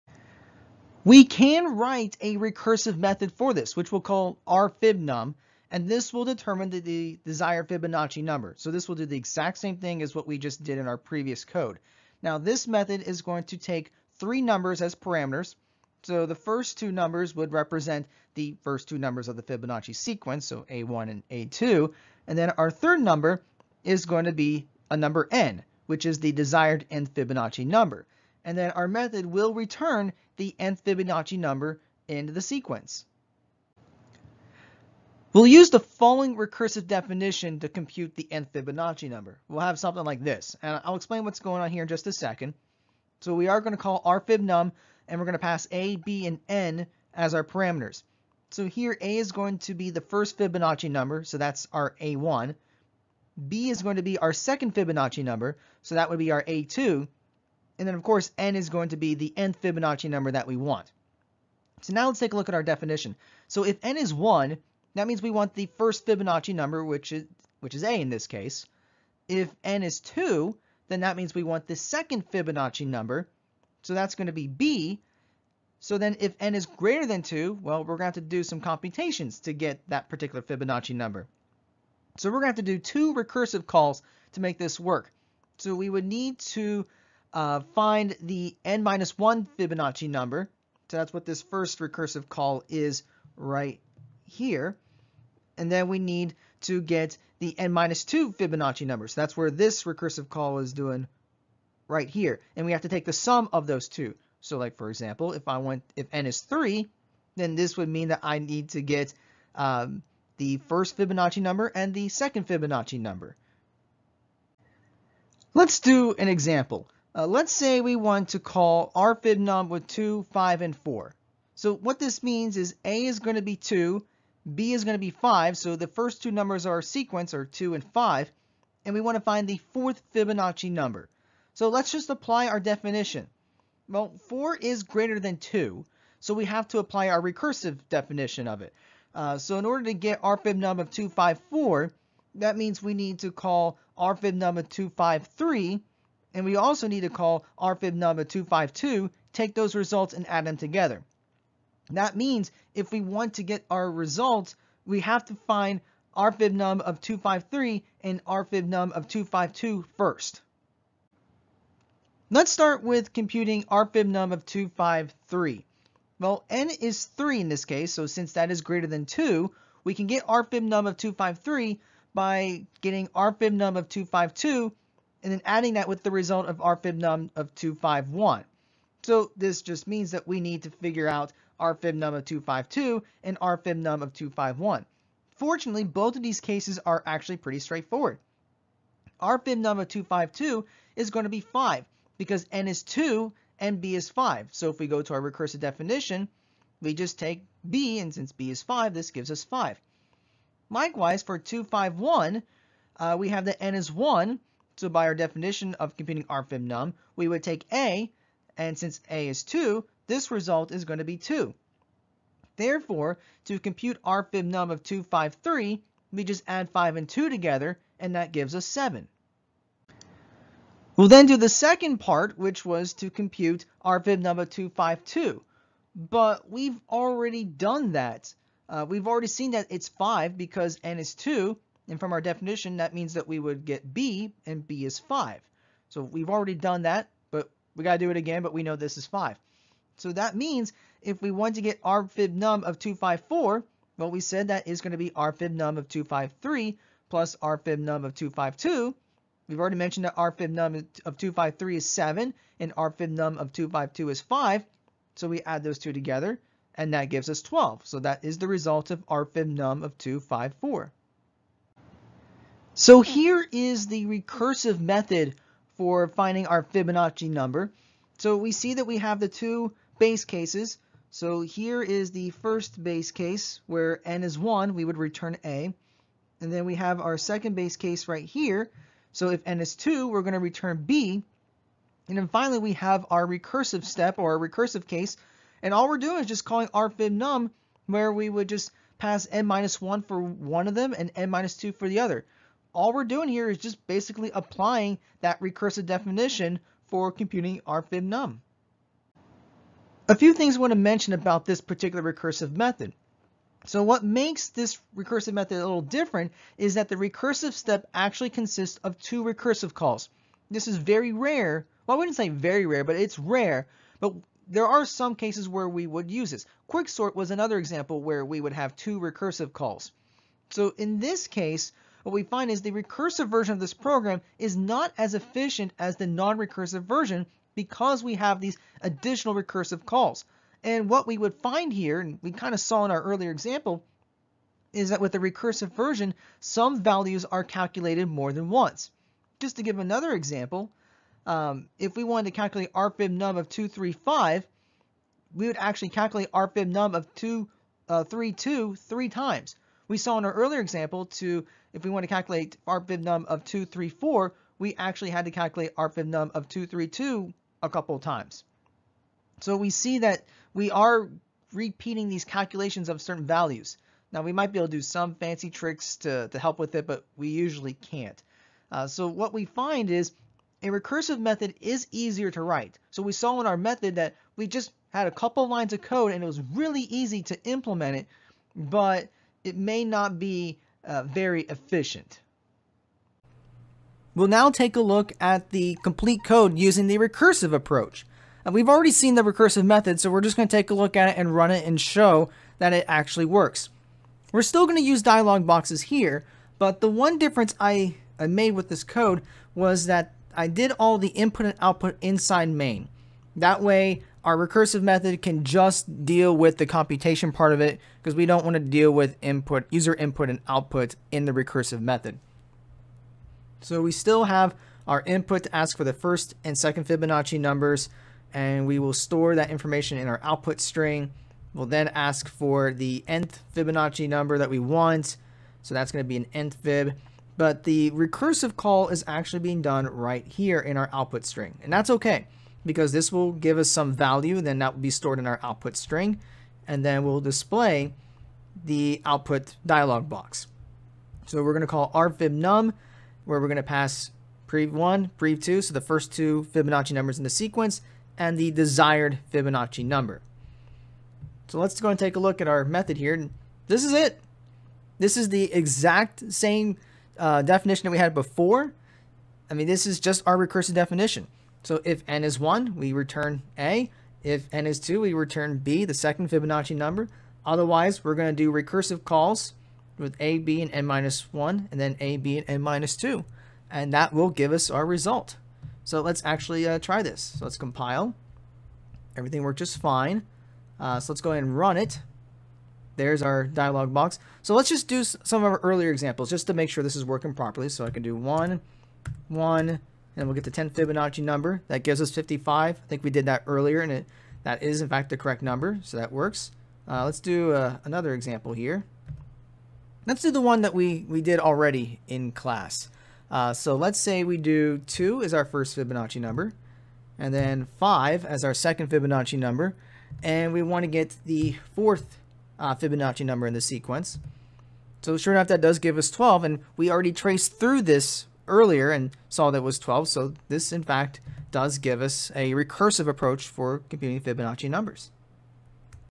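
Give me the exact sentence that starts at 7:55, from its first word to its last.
So let's actually uh, try this.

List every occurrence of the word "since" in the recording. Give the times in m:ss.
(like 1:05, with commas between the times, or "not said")
2:48, 3:18, 3:28.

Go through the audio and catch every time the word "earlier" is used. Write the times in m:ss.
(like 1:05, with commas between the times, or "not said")
5:33, 5:50, 8:05, 8:13, 8:38.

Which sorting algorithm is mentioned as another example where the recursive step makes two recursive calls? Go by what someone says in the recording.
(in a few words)
Quicksort.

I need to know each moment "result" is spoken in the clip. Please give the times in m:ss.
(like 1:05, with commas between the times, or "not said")
2:29, 2:33, 2:56, 3:30, 4:18, 7:54.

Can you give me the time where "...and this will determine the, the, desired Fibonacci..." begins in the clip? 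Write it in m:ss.
0:05.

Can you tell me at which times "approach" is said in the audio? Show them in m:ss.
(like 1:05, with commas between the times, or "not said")
6:27, 8:43.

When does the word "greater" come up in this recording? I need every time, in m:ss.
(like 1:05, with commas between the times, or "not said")
1:16, 2:14, 2:48.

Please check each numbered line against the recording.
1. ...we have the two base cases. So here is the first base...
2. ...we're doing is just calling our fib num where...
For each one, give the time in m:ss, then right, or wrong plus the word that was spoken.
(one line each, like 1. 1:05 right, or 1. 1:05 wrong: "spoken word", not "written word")
1. 4:28 right
2. 4:45 right.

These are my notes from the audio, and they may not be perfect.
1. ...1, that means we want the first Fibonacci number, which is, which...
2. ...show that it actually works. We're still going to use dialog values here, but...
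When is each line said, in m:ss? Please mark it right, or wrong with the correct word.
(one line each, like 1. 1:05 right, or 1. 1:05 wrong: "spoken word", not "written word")
1. 1:04 right
2. 6:31 wrong: "boxes", not "values".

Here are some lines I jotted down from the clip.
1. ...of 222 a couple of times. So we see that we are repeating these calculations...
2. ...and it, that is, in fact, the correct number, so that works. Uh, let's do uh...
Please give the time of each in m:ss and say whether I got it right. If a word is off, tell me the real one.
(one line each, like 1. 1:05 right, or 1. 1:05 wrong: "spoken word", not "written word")
1. 5:56 wrong: "232", not "222"
2. 8:13 right.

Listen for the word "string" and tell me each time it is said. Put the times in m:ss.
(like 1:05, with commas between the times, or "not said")
7:00, 7:11, 7:15.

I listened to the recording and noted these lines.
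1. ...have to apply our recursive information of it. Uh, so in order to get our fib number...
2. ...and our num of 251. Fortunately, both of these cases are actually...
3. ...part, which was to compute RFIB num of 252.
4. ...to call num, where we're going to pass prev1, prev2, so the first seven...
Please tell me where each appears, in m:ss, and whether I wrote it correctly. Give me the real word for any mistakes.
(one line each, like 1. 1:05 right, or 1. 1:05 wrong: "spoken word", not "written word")
1. 2:16 wrong: "definition", not "information"
2. 3:03 right
3. 3:41 right
4. 7:21 wrong: "two", not "seven".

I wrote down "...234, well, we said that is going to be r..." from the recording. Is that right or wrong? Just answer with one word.
wrong.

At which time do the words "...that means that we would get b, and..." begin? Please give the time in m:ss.
3:52.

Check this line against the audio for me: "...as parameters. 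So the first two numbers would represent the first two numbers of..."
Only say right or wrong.
right.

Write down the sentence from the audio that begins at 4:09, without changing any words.
We've already mentioned that r fib num of 253 is 7, and r fib num of 252 is 5.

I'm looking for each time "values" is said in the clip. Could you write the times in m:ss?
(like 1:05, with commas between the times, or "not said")
5:36, 6:03, 7:13.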